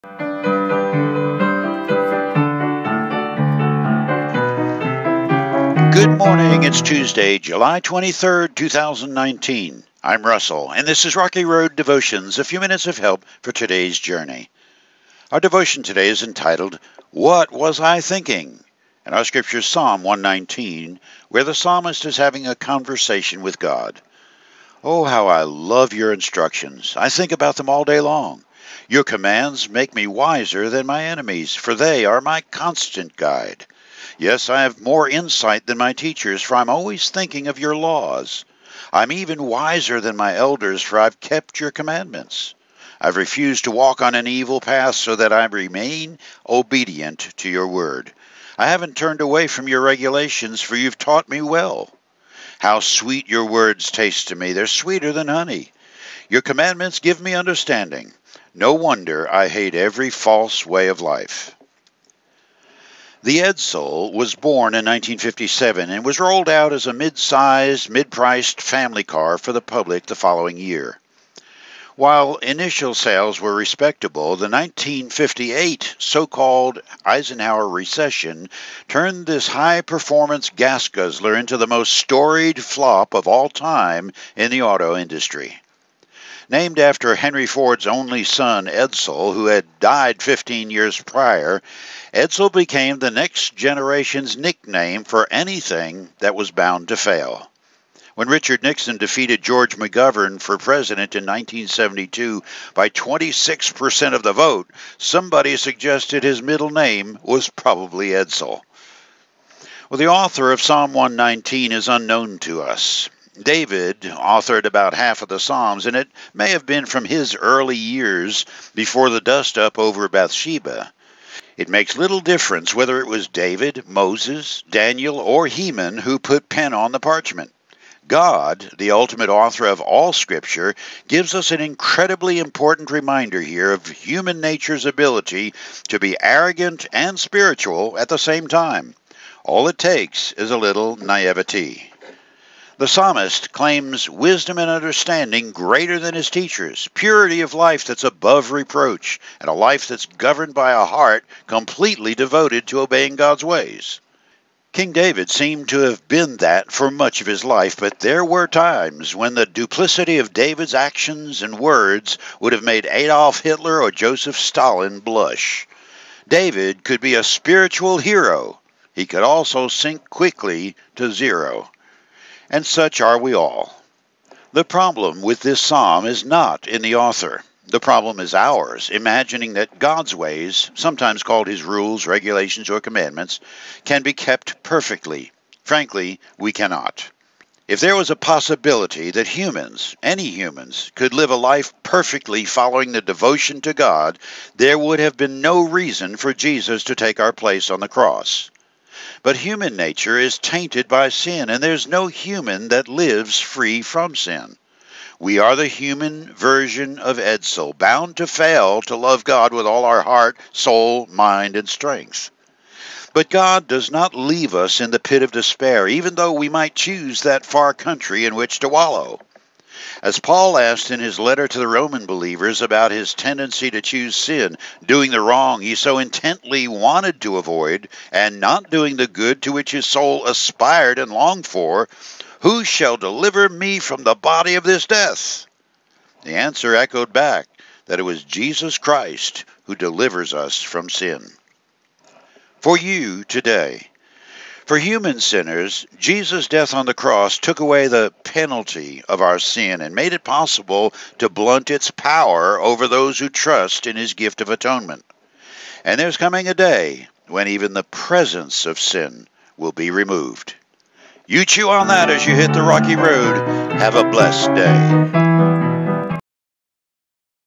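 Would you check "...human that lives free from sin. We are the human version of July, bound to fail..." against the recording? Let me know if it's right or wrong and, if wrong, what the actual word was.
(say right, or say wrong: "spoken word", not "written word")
wrong: "Edsel", not "July".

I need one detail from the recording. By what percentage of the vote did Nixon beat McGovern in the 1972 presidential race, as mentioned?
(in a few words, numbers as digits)
26%.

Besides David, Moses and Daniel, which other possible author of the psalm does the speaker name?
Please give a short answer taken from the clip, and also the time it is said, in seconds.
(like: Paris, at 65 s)
Heman, at 125 s.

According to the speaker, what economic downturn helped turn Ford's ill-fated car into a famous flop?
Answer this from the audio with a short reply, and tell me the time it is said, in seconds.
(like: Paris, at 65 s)
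Eisenhower recession, at 77 s.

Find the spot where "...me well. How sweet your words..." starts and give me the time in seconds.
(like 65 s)
51 s.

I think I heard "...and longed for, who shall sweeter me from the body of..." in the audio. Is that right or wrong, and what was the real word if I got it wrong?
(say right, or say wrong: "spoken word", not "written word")
wrong: "deliver", not "sweeter".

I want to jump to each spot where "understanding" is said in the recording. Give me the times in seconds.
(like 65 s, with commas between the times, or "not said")
57 s, 144 s.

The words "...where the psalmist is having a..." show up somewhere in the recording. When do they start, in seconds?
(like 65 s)
21 s.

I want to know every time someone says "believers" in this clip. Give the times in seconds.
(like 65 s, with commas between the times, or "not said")
222 s.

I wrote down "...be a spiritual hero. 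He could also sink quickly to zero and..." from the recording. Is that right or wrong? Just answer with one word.
right.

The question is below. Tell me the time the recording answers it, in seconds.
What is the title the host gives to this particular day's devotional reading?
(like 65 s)
17 s.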